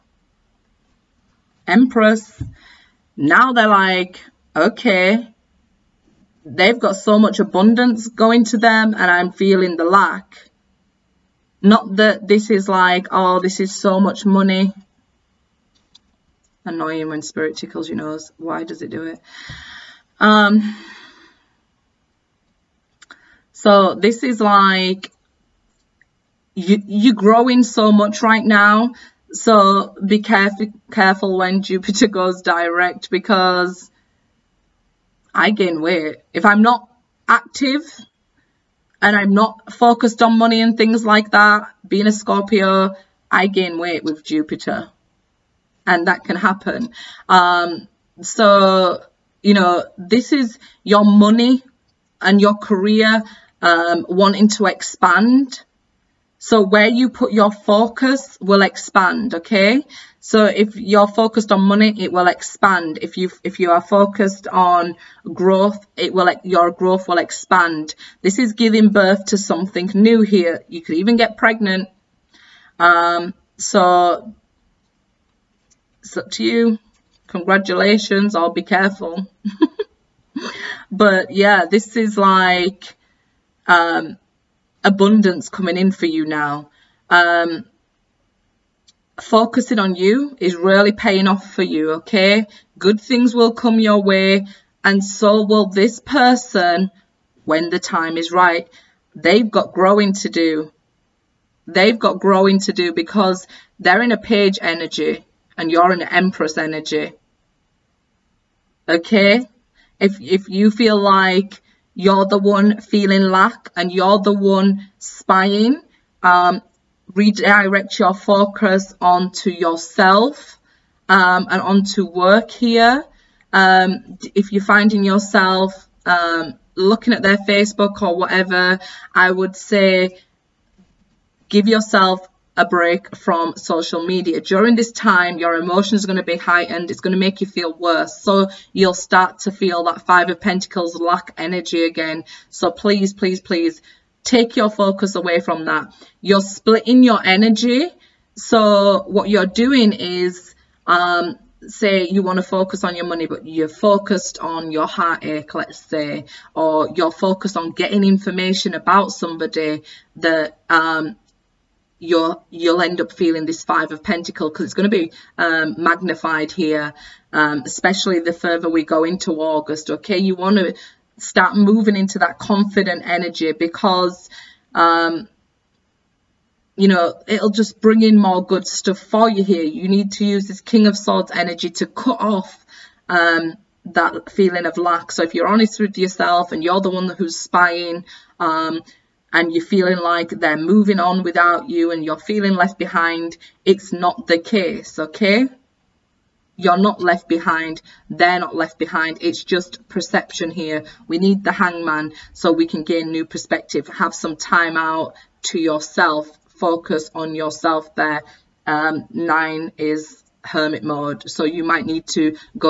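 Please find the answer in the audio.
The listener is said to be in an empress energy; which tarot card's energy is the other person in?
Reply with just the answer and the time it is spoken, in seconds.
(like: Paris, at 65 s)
Page, at 104 s.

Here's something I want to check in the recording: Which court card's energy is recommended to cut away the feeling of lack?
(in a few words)
King of Swords.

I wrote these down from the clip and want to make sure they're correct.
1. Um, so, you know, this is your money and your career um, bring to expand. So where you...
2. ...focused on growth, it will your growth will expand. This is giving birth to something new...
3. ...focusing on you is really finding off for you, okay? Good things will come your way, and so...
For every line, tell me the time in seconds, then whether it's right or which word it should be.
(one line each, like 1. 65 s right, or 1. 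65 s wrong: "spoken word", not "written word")
1. 47 s wrong: "wanting", not "bring"
2. 63 s right
3. 89 s wrong: "paying", not "finding".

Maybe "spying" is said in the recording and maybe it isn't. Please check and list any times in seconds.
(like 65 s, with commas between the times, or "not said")
114 s, 187 s.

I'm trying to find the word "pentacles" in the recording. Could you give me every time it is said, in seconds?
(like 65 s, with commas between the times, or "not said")
140 s, 164 s.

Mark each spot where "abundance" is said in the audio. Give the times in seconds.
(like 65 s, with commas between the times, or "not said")
7 s, 84 s.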